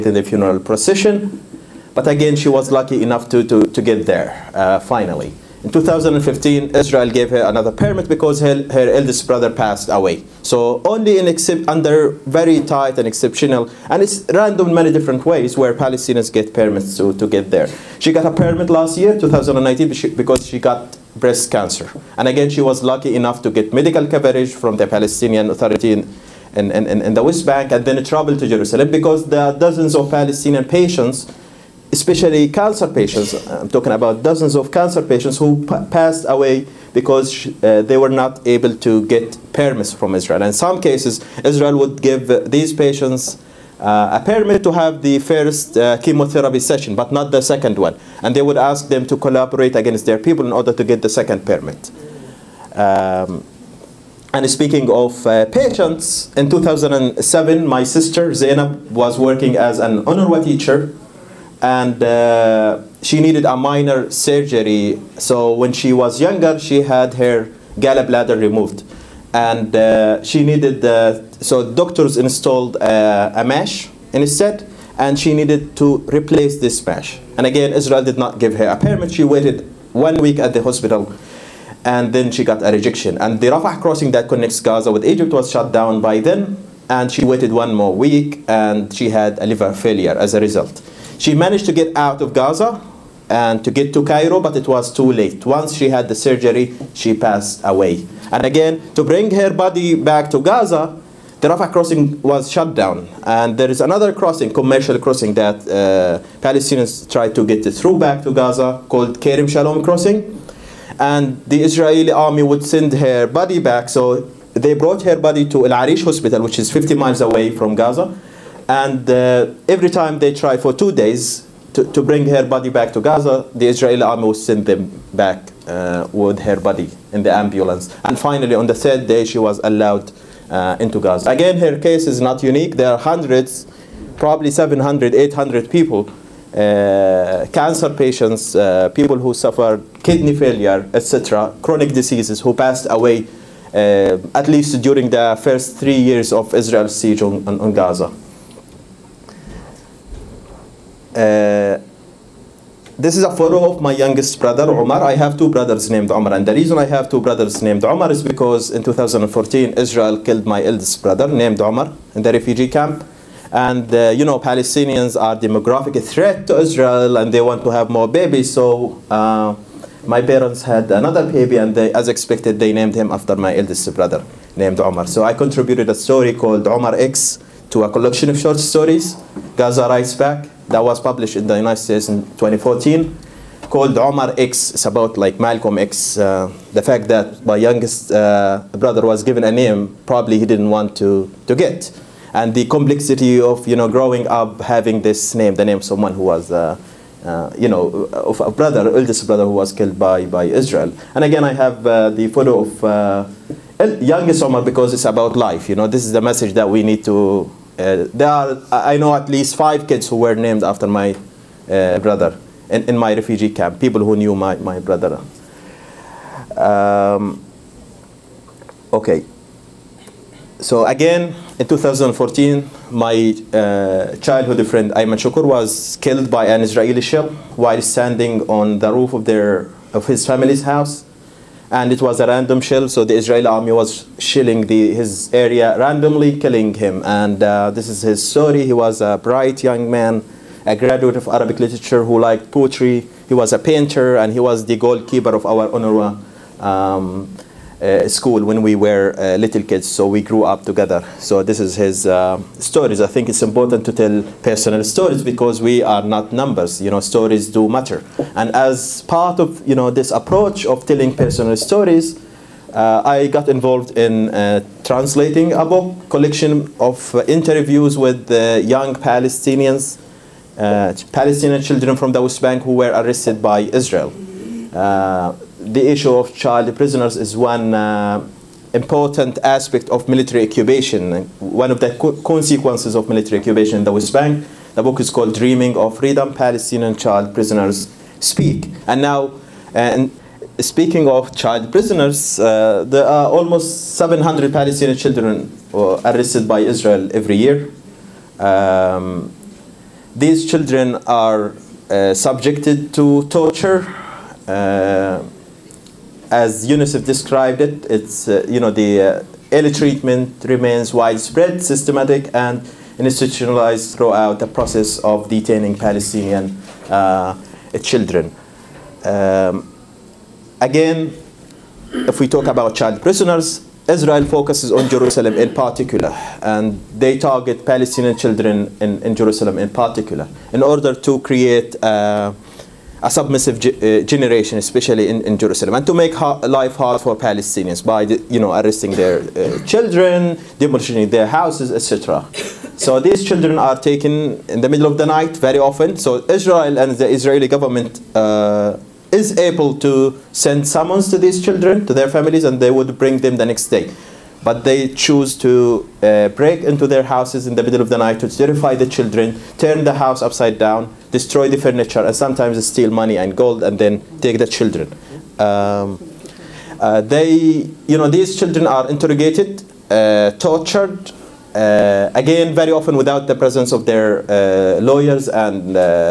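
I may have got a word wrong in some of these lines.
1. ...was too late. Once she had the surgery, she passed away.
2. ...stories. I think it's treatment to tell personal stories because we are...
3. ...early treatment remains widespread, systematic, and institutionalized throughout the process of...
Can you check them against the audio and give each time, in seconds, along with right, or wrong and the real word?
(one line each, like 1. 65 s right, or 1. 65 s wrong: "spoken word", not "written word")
1. 94 s right
2. 252 s wrong: "important", not "treatment"
3. 309 s right.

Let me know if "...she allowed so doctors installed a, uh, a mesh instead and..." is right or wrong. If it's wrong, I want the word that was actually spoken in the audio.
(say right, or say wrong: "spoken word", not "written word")
wrong: "needed", not "allowed".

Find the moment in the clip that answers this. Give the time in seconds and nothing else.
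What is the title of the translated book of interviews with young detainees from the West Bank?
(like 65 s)
285 s.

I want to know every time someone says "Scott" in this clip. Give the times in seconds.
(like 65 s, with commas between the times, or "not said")
not said.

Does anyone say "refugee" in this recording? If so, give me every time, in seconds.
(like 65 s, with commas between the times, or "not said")
162 s, 213 s.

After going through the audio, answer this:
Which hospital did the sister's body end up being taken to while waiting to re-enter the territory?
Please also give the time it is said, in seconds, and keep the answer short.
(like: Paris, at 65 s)
El Arish Hospital, at 115 s.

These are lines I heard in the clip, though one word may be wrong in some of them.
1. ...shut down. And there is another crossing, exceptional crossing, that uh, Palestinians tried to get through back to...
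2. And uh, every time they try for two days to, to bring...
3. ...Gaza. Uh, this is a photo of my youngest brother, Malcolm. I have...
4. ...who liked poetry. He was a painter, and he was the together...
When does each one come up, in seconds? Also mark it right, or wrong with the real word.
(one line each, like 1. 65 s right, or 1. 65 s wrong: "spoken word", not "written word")
1. 102 s wrong: "commercial", not "exceptional"
2. 118 s right
3. 147 s wrong: "Omar", not "Malcolm"
4. 242 s wrong: "goalkeeper", not "together".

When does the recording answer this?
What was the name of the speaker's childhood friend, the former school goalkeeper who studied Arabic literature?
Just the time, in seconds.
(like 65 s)
224 s.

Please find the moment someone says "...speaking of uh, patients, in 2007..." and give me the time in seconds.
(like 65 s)
54 s.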